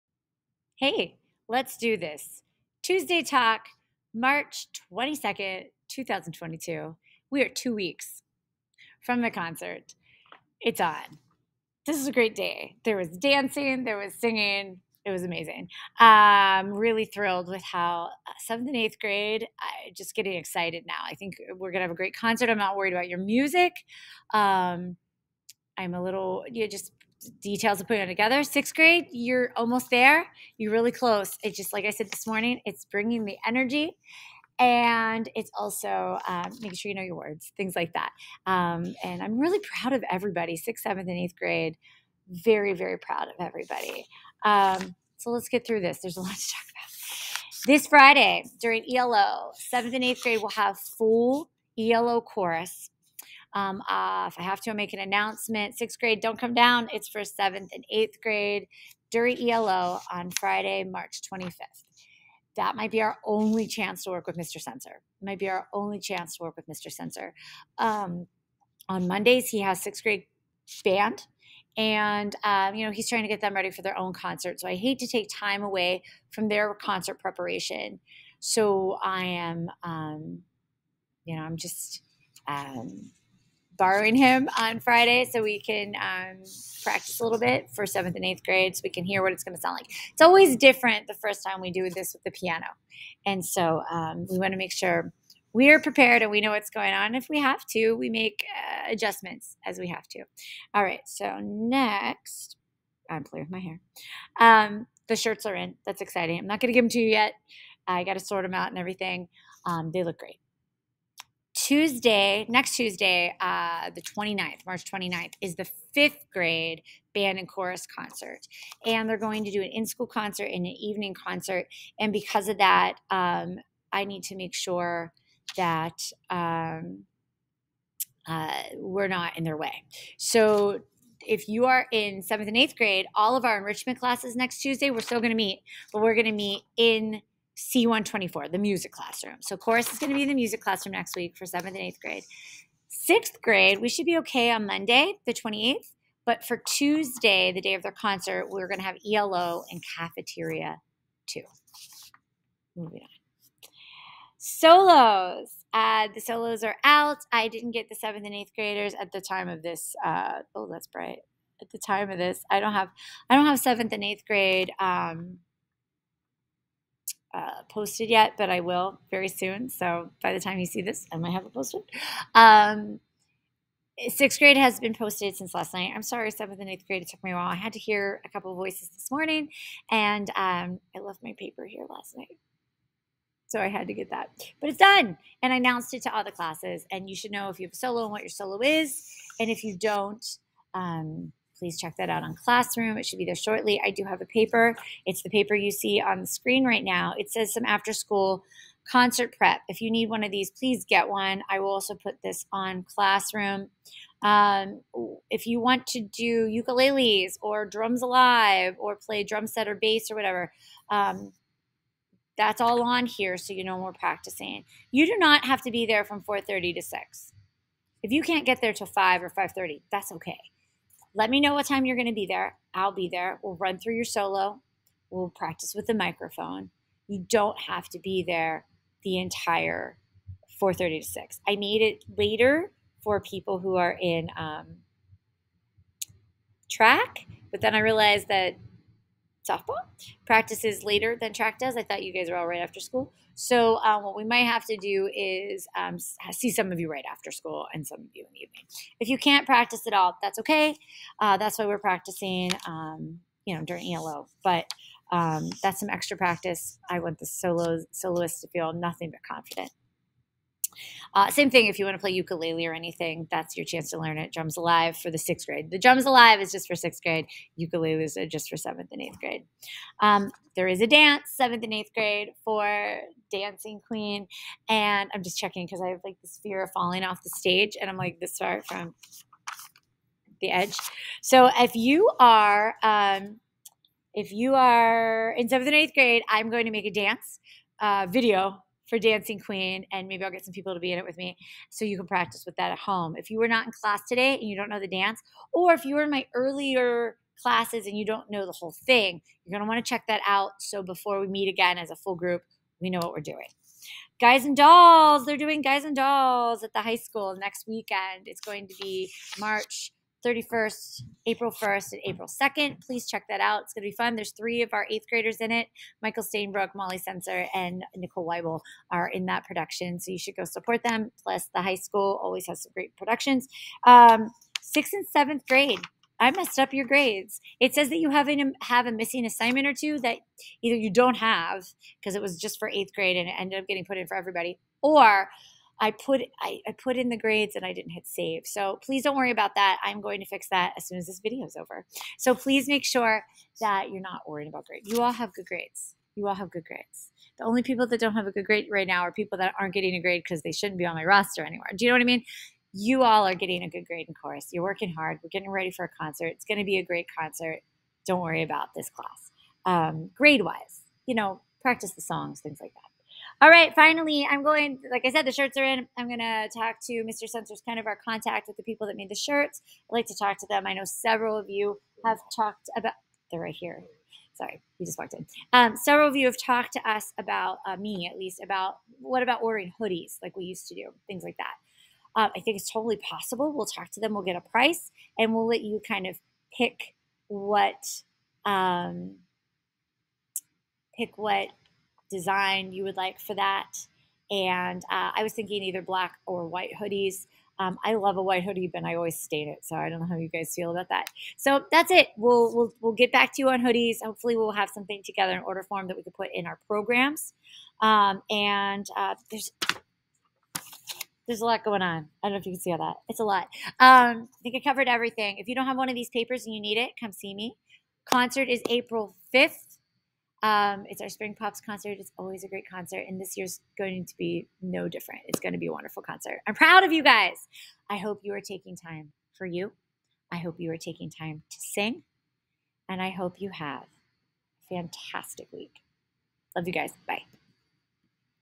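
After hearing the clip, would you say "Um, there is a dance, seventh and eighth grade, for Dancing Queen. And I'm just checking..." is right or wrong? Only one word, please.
right.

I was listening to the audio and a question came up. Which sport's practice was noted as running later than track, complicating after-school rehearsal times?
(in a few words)
Softball.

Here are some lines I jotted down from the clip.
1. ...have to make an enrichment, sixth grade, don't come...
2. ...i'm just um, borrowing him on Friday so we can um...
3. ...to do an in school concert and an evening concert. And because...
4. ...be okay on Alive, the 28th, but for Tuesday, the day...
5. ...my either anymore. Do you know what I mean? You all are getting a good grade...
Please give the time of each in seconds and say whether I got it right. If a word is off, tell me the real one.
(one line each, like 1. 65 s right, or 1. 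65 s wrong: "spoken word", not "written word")
1. 54 s wrong: "announcement", not "enrichment"
2. 81 s right
3. 119 s right
4. 144 s wrong: "Monday", not "Alive"
5. 350 s wrong: "roster", not "either".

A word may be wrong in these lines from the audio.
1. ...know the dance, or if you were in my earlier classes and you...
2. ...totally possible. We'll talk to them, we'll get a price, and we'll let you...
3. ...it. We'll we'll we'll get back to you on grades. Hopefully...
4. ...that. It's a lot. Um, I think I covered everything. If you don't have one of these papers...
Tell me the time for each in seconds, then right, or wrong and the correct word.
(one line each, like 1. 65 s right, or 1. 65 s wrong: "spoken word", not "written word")
1. 294 s right
2. 382 s right
3. 401 s wrong: "hoodies", not "grades"
4. 412 s right.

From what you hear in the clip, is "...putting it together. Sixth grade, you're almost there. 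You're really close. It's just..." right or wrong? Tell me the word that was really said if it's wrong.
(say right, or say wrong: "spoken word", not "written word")
right.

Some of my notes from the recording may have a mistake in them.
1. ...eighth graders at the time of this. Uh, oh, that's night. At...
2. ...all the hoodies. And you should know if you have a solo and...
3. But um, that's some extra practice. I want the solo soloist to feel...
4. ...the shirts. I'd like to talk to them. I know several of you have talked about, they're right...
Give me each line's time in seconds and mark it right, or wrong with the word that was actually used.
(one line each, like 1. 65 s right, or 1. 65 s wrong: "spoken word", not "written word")
1. 158 s wrong: "bright", not "night"
2. 186 s wrong: "classes", not "hoodies"
3. 254 s right
4. 369 s right.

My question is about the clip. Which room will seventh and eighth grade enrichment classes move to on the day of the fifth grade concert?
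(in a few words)
C124.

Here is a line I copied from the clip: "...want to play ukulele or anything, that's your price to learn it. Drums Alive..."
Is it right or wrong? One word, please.
wrong.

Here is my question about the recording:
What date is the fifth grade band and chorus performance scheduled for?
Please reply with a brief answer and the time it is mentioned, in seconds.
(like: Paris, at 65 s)
March 29th, at 114 s.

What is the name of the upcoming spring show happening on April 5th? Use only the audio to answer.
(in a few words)
Spring Pops concert.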